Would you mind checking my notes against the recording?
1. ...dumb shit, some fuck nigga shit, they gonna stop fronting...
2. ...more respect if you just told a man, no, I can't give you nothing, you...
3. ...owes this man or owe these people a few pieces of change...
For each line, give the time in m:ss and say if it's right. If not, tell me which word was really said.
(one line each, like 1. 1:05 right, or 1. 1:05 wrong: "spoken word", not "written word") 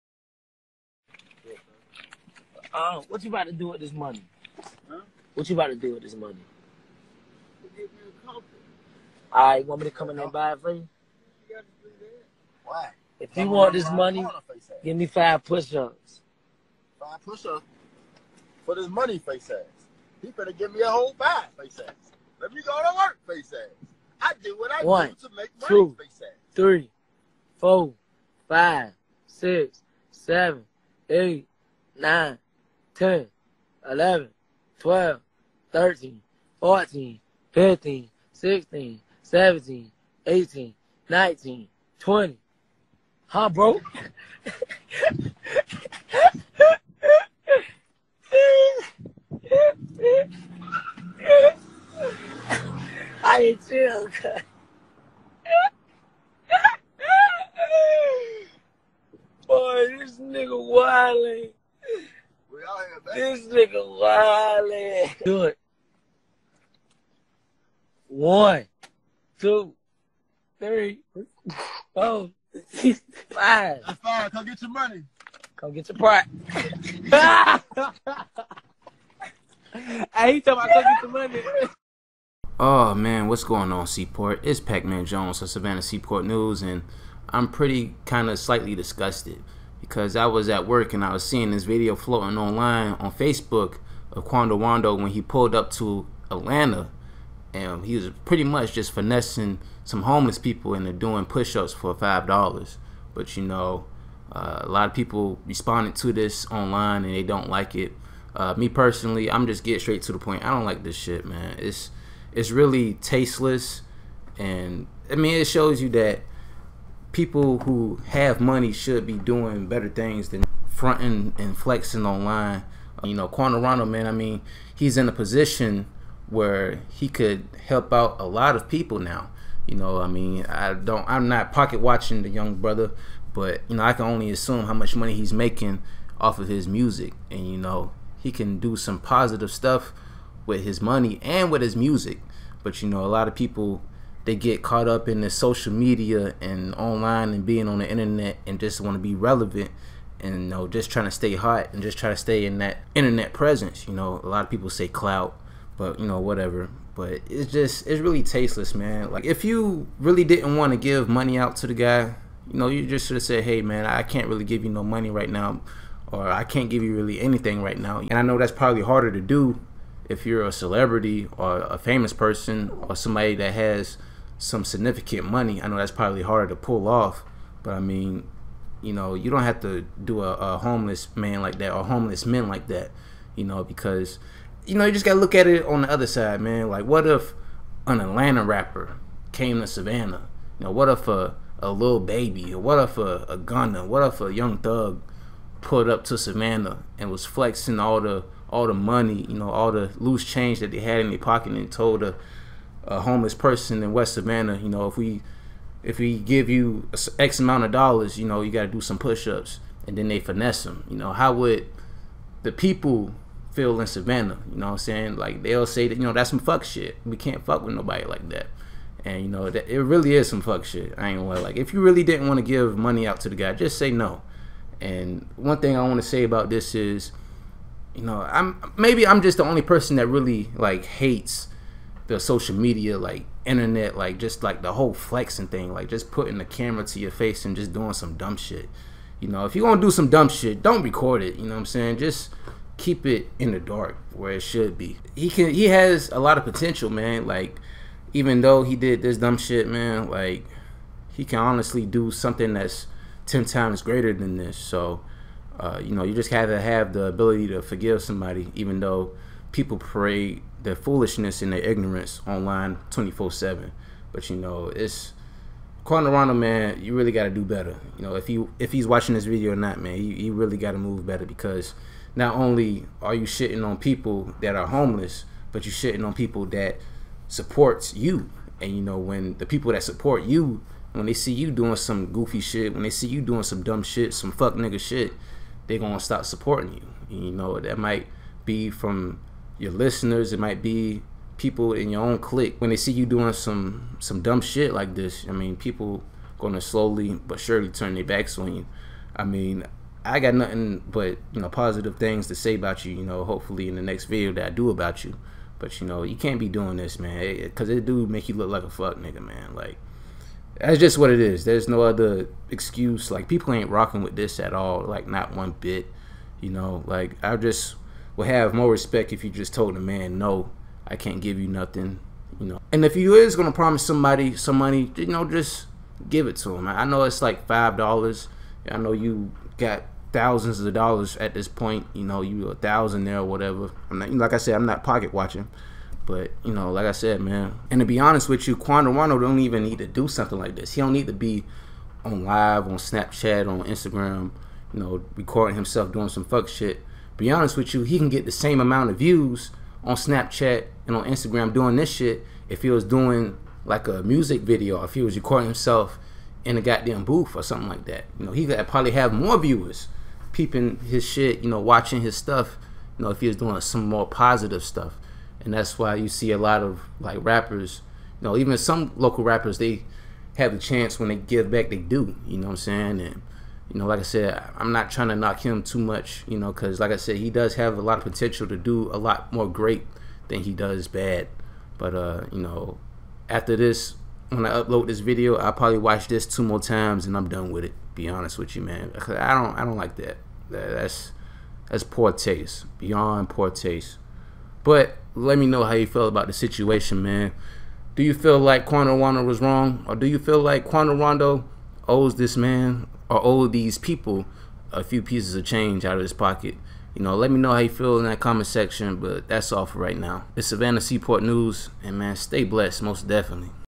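1. 4:43 wrong: "supporting", not "fronting"
2. 5:18 right
3. 6:41 right.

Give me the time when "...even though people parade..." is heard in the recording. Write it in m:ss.
4:18.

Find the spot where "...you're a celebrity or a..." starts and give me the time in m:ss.
2:50.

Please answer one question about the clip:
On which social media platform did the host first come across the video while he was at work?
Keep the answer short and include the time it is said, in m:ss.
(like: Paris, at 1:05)
Facebook, at 1:33.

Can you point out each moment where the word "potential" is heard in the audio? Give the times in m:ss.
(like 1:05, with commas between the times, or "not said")
4:06, 6:18.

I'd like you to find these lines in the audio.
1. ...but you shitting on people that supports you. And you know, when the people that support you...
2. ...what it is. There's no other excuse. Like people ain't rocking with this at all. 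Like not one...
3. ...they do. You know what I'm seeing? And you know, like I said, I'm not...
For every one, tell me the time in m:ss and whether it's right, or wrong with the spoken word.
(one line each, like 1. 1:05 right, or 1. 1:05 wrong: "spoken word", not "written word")
1. 4:35 right
2. 5:10 right
3. 6:11 wrong: "saying", not "seeing".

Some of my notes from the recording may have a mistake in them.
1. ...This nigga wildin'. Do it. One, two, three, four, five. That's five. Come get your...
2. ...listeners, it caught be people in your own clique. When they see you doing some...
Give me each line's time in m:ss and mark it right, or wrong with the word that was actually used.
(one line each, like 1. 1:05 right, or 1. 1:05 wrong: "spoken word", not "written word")
1. 1:03 right
2. 4:49 wrong: "might", not "caught".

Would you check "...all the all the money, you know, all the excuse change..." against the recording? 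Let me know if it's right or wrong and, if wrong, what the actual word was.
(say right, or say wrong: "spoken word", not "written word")
wrong: "loose", not "excuse".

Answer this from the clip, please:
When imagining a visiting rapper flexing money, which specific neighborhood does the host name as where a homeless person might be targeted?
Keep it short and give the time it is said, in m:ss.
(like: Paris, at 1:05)
West Savannah, at 3:23.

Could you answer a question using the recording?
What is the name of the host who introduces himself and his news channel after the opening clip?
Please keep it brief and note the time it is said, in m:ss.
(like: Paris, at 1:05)
Pac Man Jones, at 1:24.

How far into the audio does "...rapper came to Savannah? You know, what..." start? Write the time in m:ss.
3:08.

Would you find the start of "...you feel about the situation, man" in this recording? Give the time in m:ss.
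6:35.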